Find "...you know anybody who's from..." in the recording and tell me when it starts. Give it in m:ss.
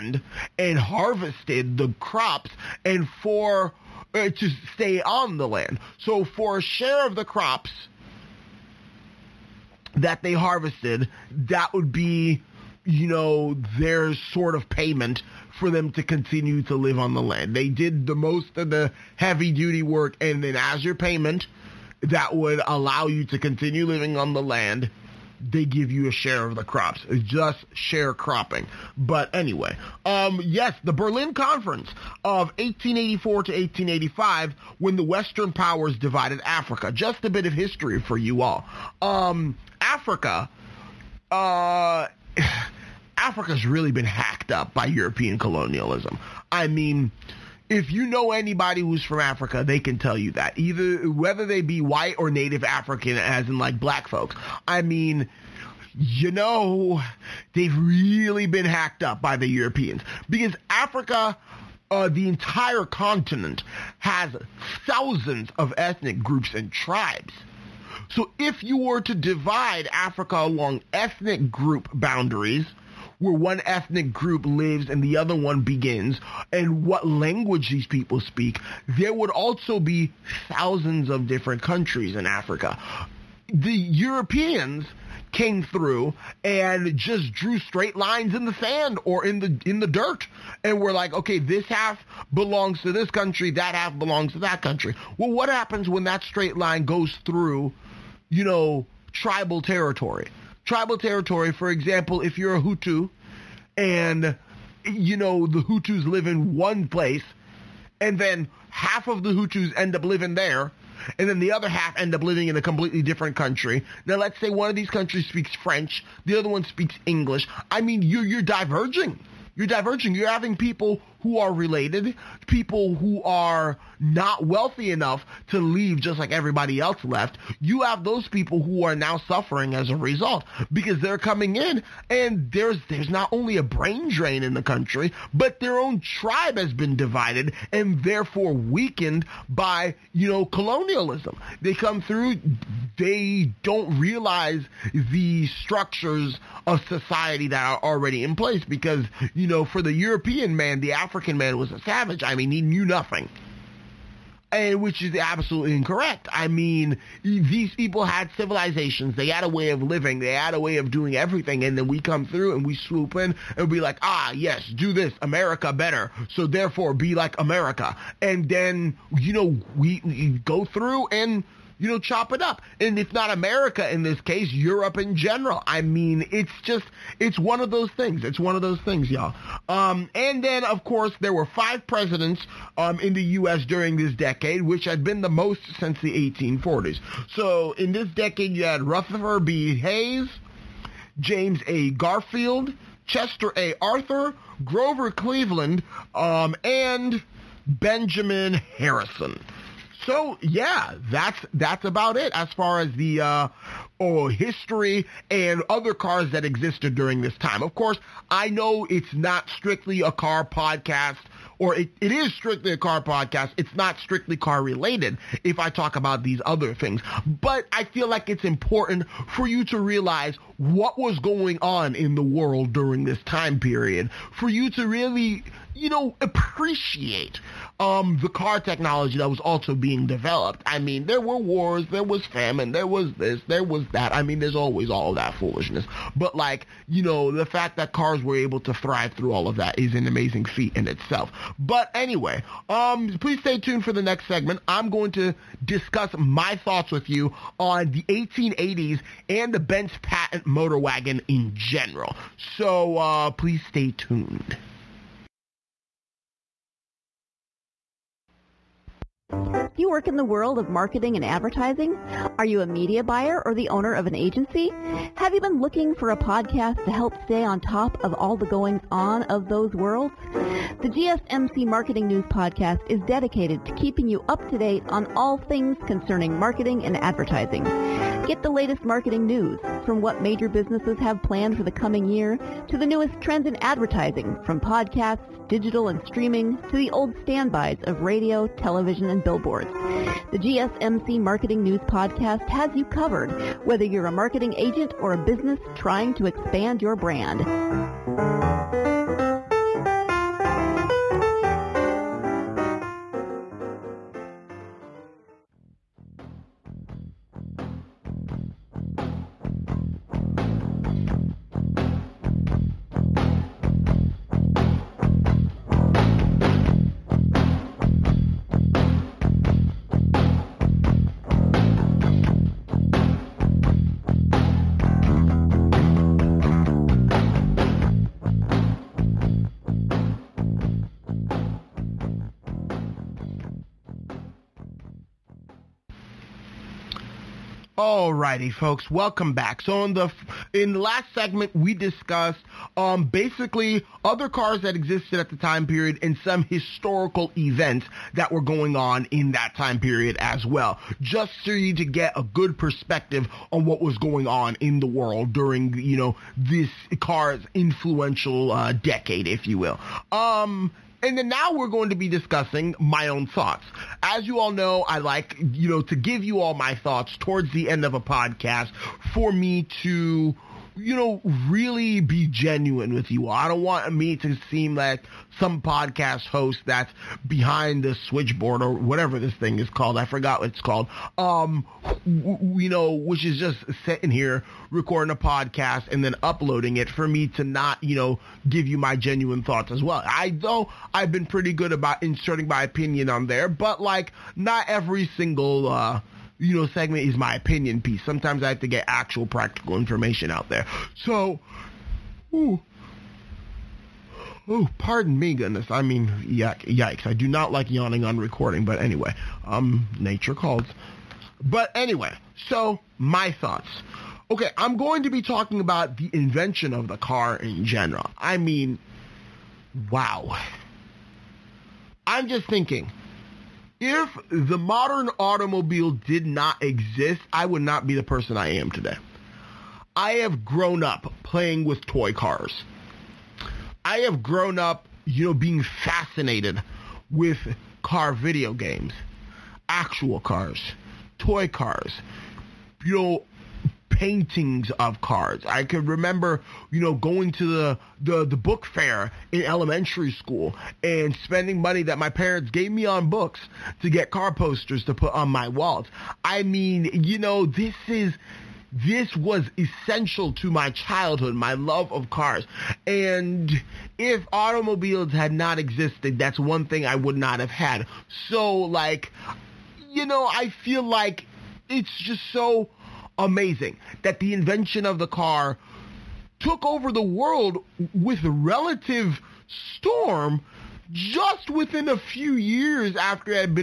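0:47.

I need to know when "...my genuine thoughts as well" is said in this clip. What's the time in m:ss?
6:28.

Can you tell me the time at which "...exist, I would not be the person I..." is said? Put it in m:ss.
7:06.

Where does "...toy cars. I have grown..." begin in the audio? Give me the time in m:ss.
7:11.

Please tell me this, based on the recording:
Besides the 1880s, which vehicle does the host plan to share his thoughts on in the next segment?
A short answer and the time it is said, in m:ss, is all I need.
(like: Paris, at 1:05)
Benz Patent Motor Wagon, at 4:09.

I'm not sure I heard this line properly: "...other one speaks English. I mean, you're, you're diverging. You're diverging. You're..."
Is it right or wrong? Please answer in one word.
right.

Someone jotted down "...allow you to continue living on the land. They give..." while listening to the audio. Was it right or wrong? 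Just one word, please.
right.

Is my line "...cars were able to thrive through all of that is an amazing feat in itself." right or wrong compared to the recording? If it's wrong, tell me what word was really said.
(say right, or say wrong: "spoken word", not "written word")
right.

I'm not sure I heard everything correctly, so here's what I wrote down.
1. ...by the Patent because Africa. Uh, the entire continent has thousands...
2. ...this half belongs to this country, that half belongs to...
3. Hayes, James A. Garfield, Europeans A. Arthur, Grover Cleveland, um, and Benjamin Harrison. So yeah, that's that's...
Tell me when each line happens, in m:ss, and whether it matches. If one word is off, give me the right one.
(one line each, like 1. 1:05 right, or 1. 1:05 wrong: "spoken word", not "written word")
1. 0:59 wrong: "Europeans", not "Patent"
2. 1:31 right
3. 3:09 wrong: "Chester", not "Europeans".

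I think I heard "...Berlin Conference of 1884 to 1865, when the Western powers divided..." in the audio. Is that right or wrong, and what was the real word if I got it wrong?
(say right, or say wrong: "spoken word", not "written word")
wrong: "1885", not "1865".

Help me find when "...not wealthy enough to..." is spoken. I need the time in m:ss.
2:03.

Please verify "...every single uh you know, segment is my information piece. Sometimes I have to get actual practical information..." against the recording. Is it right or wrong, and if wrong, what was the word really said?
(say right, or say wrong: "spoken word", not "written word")
wrong: "opinion", not "information".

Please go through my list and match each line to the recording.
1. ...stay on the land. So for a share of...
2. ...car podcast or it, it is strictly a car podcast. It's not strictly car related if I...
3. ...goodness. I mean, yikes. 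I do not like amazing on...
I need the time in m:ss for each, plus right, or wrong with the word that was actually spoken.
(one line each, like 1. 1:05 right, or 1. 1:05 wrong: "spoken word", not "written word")
1. 0:04 right
2. 3:30 right
3. 6:45 wrong: "yawning", not "amazing".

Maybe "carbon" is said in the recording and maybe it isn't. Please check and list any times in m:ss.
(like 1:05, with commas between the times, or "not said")
not said.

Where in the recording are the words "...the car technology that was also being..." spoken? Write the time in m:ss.
3:48.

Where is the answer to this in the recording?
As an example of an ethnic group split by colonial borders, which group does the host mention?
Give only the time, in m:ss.
1:42.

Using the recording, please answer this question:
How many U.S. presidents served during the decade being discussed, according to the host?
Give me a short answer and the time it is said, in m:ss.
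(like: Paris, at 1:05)
5, at 3:01.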